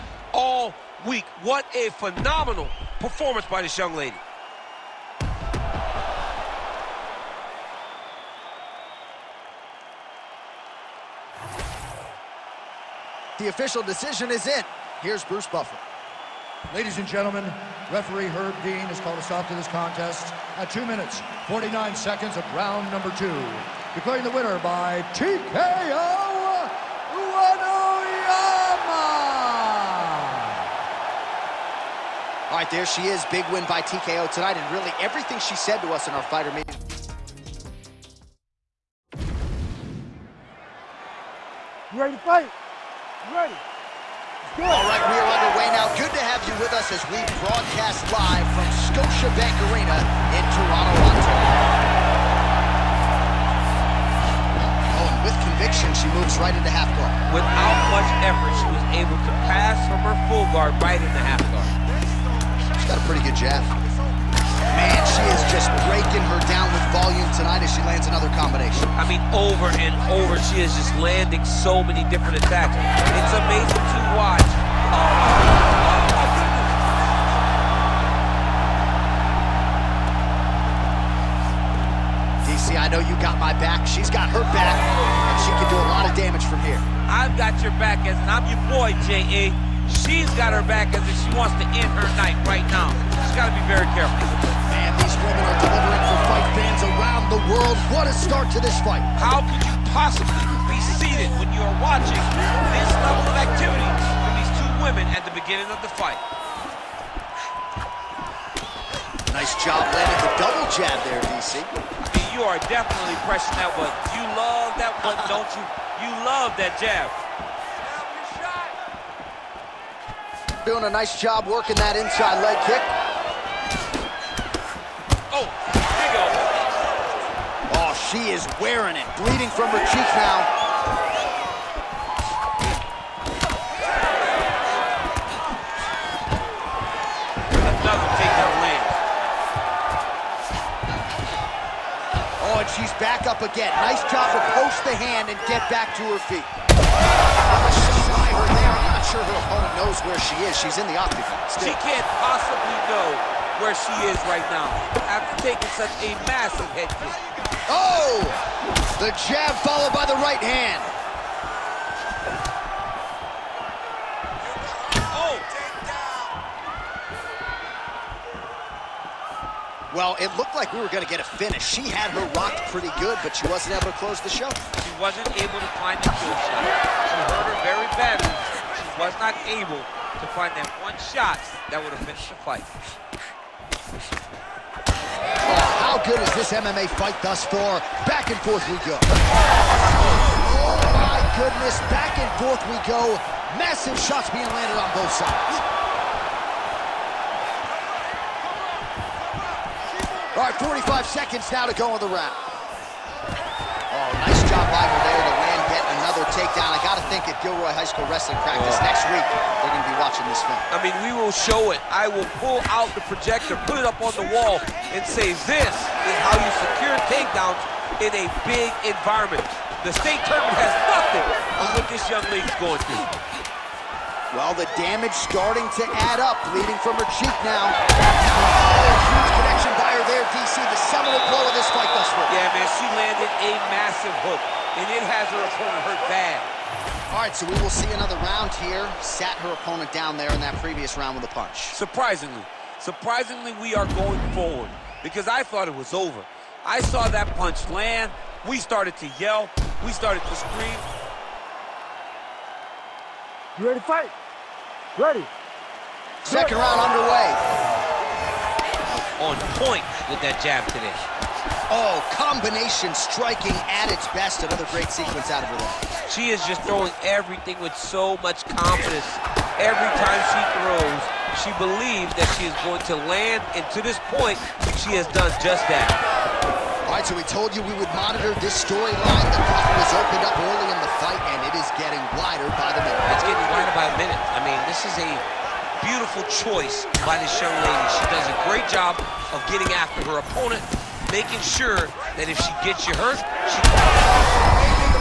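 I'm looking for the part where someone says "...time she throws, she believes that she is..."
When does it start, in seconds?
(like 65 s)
270 s.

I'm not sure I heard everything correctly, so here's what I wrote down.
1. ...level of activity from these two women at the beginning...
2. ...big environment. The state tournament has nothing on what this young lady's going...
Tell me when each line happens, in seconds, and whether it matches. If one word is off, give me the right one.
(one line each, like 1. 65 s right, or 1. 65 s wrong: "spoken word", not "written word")
1. 103 s right
2. 218 s right.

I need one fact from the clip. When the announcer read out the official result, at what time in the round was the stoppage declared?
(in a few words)
2 minutes, 49 seconds.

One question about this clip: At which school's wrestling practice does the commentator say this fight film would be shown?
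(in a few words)
Gilroy High School.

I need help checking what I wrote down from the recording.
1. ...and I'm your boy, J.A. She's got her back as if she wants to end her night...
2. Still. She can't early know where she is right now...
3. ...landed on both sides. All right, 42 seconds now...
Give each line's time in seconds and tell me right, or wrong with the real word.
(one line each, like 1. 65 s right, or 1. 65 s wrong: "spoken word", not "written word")
1. 88 s right
2. 151 s wrong: "possibly", not "early"
3. 194 s wrong: "45", not "42".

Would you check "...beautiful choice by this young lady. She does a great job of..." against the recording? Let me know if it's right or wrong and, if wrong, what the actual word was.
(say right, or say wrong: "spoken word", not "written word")
right.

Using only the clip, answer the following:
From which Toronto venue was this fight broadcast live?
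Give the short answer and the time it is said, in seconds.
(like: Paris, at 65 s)
Scotiabank Arena, at 48 s.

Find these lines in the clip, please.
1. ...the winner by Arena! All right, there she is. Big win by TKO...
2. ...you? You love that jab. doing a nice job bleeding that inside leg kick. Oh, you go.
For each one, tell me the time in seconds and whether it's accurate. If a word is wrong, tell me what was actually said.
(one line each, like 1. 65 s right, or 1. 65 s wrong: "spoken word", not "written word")
1. 24 s wrong: "TKO", not "Arena"
2. 115 s wrong: "working", not "bleeding".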